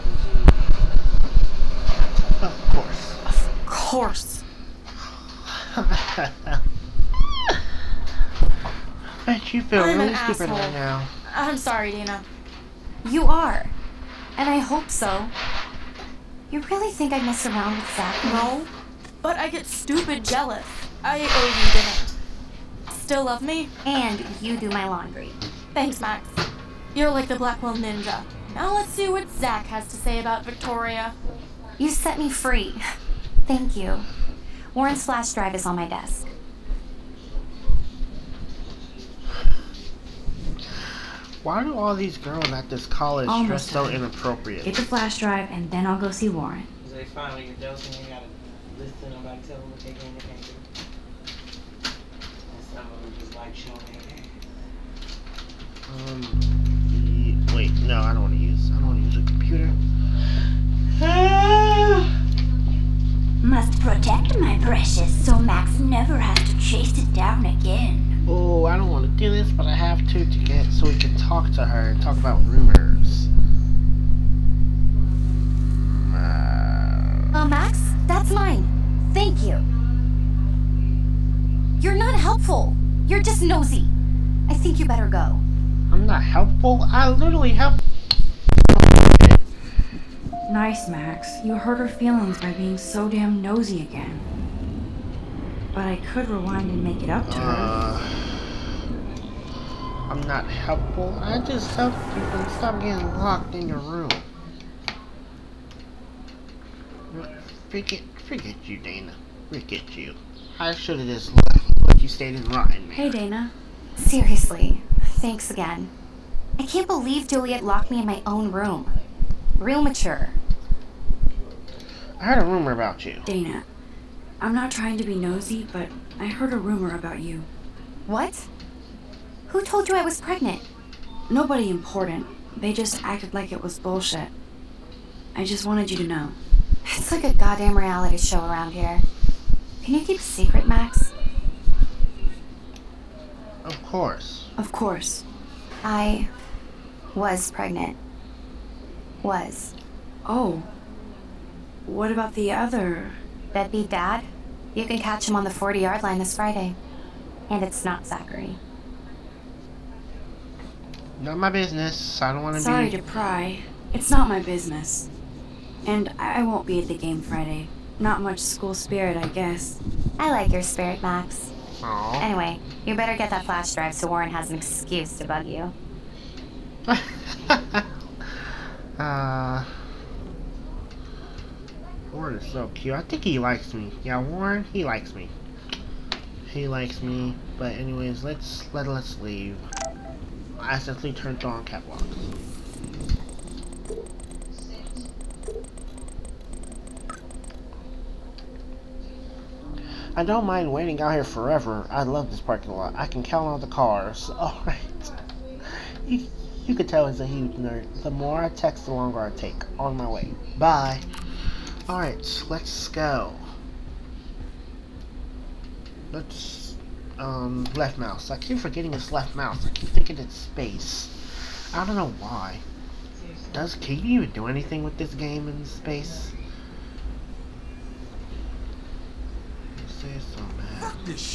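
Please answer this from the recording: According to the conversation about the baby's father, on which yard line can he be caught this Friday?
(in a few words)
40.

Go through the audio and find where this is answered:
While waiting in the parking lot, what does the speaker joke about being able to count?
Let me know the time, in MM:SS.
03:23.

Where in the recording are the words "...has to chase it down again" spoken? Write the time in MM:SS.
01:06.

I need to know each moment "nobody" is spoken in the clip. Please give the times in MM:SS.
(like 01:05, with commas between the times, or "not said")
00:49, 02:11.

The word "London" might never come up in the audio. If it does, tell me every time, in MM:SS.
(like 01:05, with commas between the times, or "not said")
not said.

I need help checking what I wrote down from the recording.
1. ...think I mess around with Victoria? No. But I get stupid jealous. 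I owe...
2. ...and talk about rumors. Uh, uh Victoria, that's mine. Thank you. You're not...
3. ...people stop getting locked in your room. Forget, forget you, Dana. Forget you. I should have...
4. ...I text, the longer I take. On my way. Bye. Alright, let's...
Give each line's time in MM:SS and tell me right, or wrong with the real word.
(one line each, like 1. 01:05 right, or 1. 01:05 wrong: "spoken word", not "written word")
1. 00:16 wrong: "Zach", not "Victoria"
2. 01:11 wrong: "Max", not "Victoria"
3. 01:42 right
4. 03:28 right.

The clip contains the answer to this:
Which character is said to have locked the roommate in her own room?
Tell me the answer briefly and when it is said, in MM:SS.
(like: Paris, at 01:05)
Juliet, at 01:57.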